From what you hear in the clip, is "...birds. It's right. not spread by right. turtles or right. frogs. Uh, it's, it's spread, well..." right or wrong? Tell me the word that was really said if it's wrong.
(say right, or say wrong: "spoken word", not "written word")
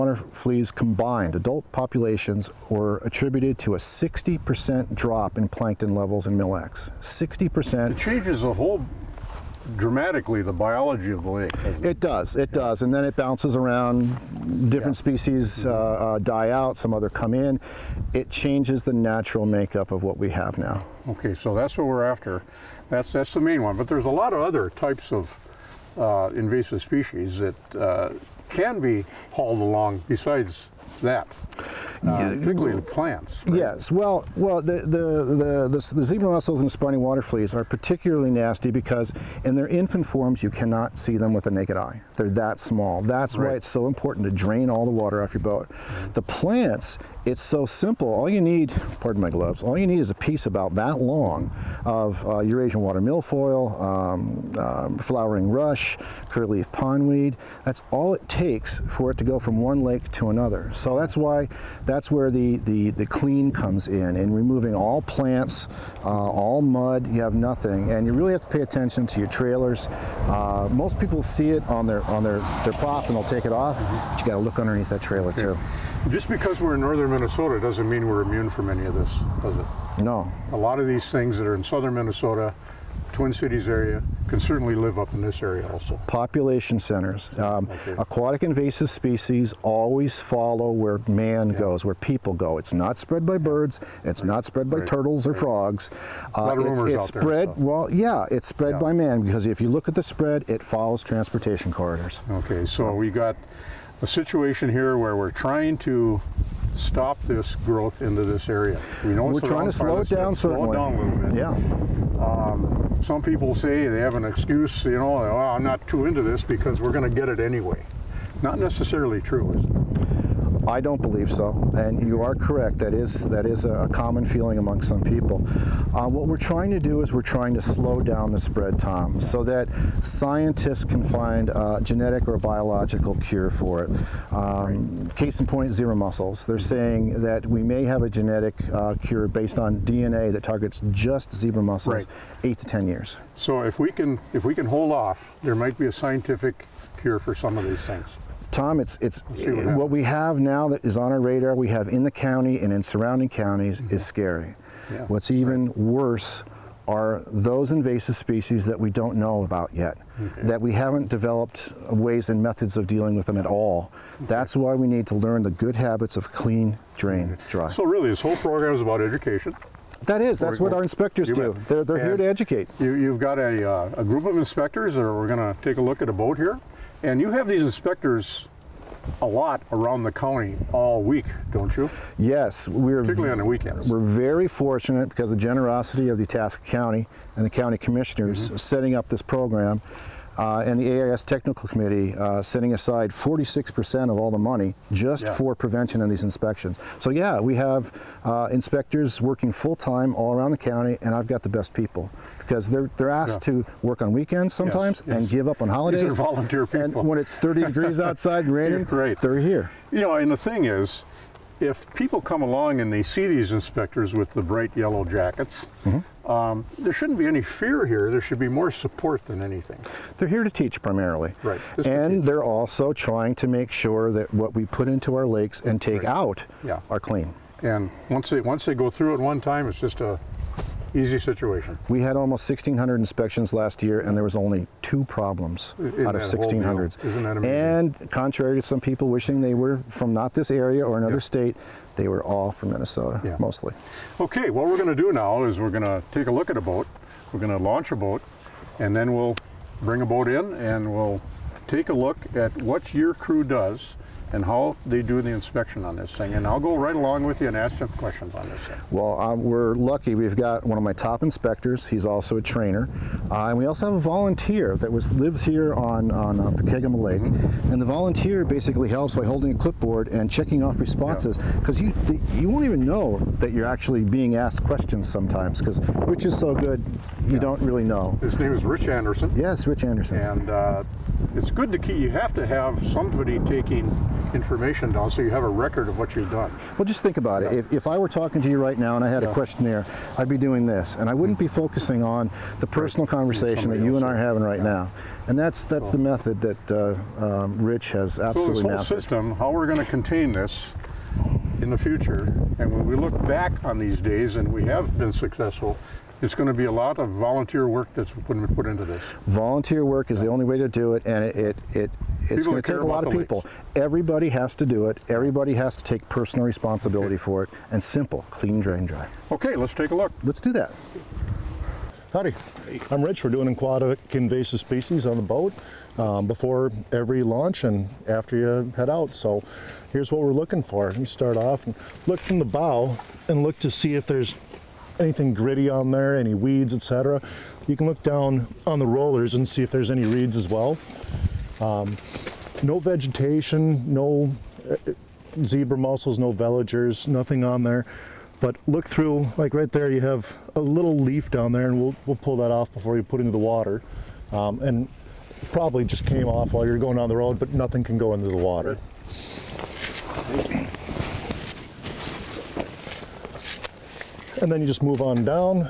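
right.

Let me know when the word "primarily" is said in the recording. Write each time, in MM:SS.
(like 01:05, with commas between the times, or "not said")
03:40.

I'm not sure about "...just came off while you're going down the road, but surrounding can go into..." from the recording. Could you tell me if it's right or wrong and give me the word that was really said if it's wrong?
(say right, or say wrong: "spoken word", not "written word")
wrong: "nothing", not "surrounding".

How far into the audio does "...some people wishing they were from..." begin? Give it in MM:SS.
03:58.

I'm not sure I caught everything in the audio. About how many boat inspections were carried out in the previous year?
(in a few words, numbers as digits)
1,600.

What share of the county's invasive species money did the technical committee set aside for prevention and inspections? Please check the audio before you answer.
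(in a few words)
46%.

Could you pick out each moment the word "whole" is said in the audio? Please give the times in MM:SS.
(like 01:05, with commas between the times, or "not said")
00:08, 02:48, 04:58.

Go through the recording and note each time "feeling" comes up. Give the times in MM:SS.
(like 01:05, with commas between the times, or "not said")
02:04.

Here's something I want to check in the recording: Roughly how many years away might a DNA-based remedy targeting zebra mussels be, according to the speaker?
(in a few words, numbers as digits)
8 to 10 years.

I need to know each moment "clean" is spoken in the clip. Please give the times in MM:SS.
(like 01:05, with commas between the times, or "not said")
01:03, 02:46, 03:46, 05:18.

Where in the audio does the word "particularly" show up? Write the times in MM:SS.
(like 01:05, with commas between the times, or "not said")
00:37, 03:03.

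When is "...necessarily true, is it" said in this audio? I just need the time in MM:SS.
01:58.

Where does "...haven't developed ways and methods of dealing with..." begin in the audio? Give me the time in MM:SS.
02:40.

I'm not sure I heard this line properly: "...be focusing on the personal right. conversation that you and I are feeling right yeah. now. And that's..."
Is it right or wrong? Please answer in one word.
wrong.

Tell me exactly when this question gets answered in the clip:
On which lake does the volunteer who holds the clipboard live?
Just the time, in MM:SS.
04:26.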